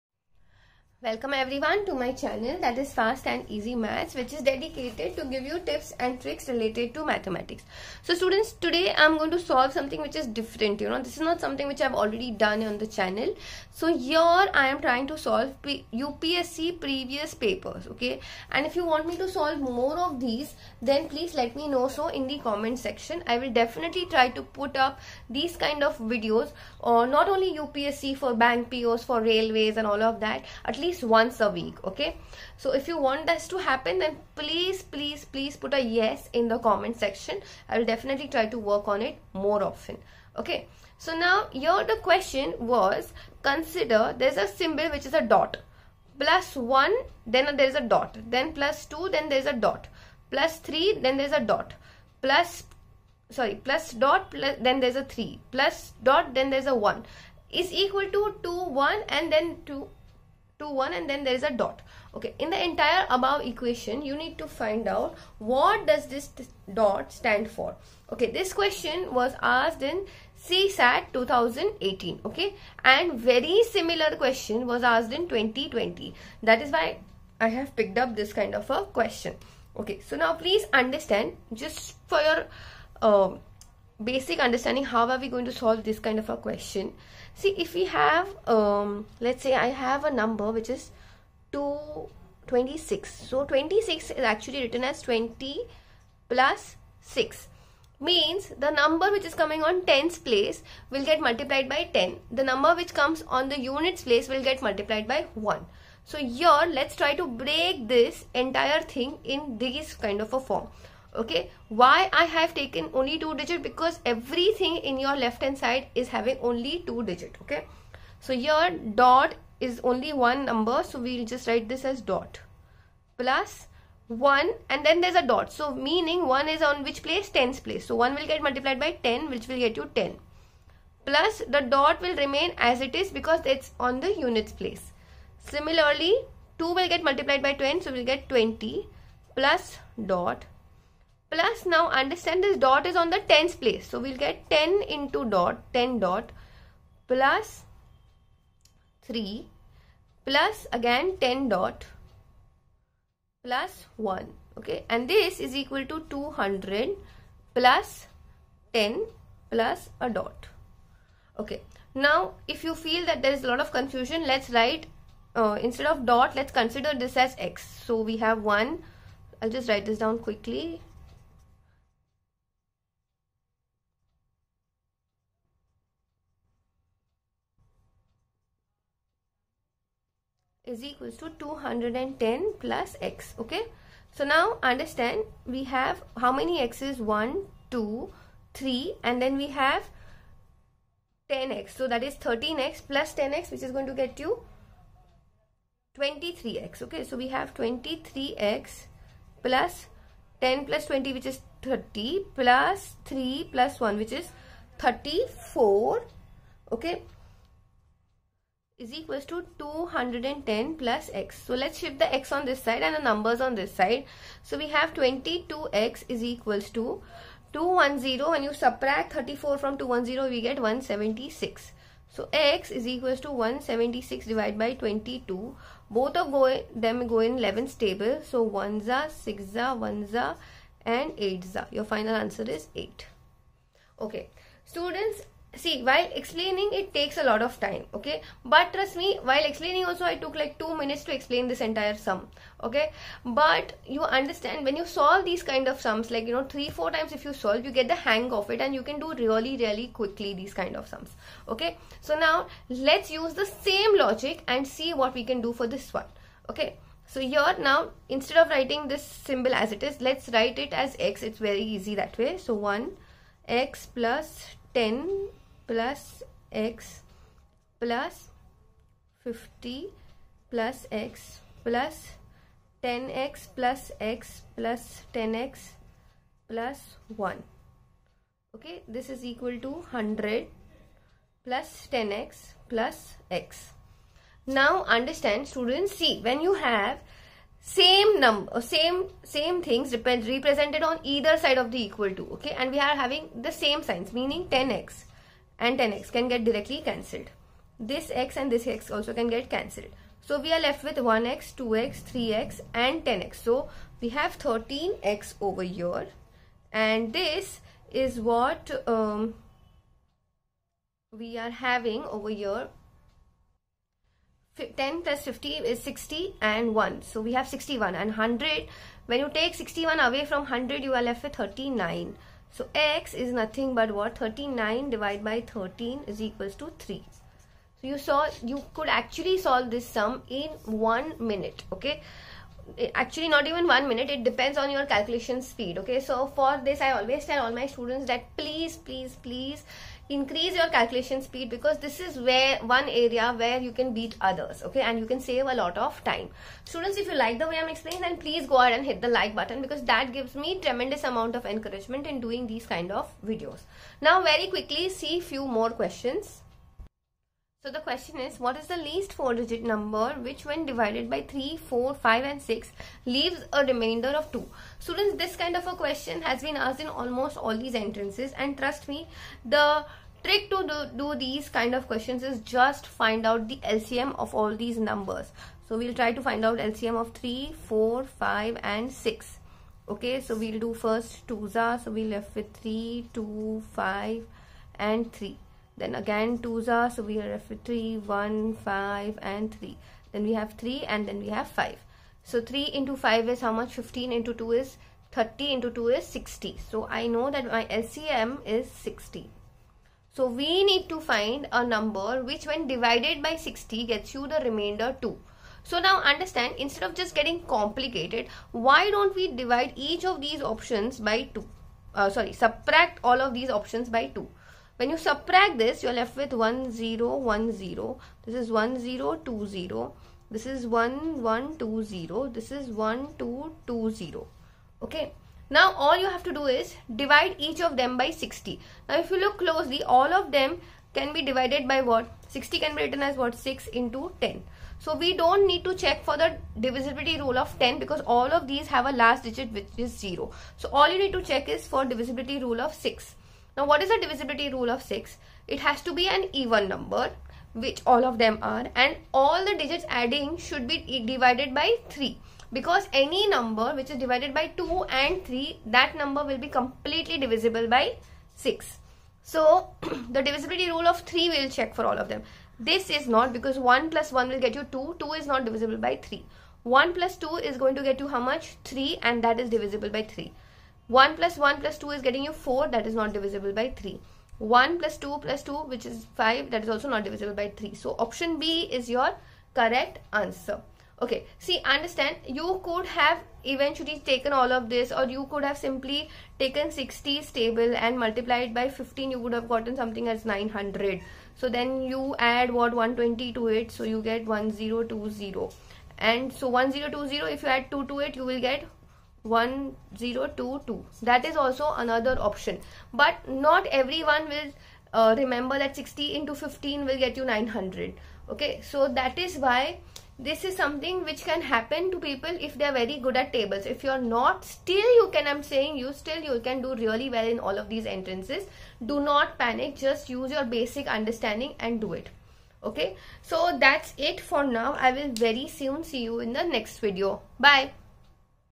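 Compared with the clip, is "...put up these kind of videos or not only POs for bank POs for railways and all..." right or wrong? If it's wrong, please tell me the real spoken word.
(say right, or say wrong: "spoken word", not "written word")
wrong: "UPSC", not "POs".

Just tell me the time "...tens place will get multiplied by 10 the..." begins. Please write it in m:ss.
1:39.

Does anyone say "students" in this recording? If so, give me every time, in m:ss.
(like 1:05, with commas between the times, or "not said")
0:08, 3:54, 4:45, 5:37, 5:46, 6:04.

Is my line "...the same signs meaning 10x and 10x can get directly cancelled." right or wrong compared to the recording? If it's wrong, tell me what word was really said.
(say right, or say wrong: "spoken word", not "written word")
right.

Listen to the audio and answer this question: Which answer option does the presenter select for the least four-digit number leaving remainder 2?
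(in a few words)
option b.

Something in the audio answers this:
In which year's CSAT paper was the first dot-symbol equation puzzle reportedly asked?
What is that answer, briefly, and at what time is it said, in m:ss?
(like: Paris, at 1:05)
2018, at 1:10.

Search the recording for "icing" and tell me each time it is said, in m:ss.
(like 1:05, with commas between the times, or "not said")
not said.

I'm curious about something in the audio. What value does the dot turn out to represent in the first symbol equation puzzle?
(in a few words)
8.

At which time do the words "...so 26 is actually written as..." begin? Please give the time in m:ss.
1:33.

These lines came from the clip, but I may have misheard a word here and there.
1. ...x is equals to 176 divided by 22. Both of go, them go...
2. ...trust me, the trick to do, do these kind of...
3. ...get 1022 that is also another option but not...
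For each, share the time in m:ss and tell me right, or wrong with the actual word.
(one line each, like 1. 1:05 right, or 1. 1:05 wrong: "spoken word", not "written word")
1. 3:42 right
2. 6:08 right
3. 8:18 right.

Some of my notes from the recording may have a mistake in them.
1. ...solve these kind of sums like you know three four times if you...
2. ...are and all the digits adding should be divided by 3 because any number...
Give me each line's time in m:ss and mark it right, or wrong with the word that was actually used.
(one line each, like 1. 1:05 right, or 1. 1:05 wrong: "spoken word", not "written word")
1. 4:04 right
2. 7:28 right.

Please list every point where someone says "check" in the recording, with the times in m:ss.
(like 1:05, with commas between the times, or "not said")
7:15, 7:21, 7:41.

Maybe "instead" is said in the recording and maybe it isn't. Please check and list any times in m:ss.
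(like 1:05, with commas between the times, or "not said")
2:45, 4:18, 6:46.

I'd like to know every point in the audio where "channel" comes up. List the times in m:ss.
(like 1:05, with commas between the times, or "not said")
0:02, 0:12.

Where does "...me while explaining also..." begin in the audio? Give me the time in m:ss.
3:58.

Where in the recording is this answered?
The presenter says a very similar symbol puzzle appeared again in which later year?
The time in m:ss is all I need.
1:15.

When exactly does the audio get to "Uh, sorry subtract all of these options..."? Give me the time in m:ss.
6:51.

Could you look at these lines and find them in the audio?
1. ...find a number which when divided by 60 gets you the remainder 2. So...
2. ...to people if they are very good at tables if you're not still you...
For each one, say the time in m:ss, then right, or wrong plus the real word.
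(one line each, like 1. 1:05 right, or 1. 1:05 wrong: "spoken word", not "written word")
1. 6:40 right
2. 8:31 right.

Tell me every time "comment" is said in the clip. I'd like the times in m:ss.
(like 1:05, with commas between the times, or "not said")
0:22, 0:36.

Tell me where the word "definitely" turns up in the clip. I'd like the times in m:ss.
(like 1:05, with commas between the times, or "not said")
0:23, 0:37.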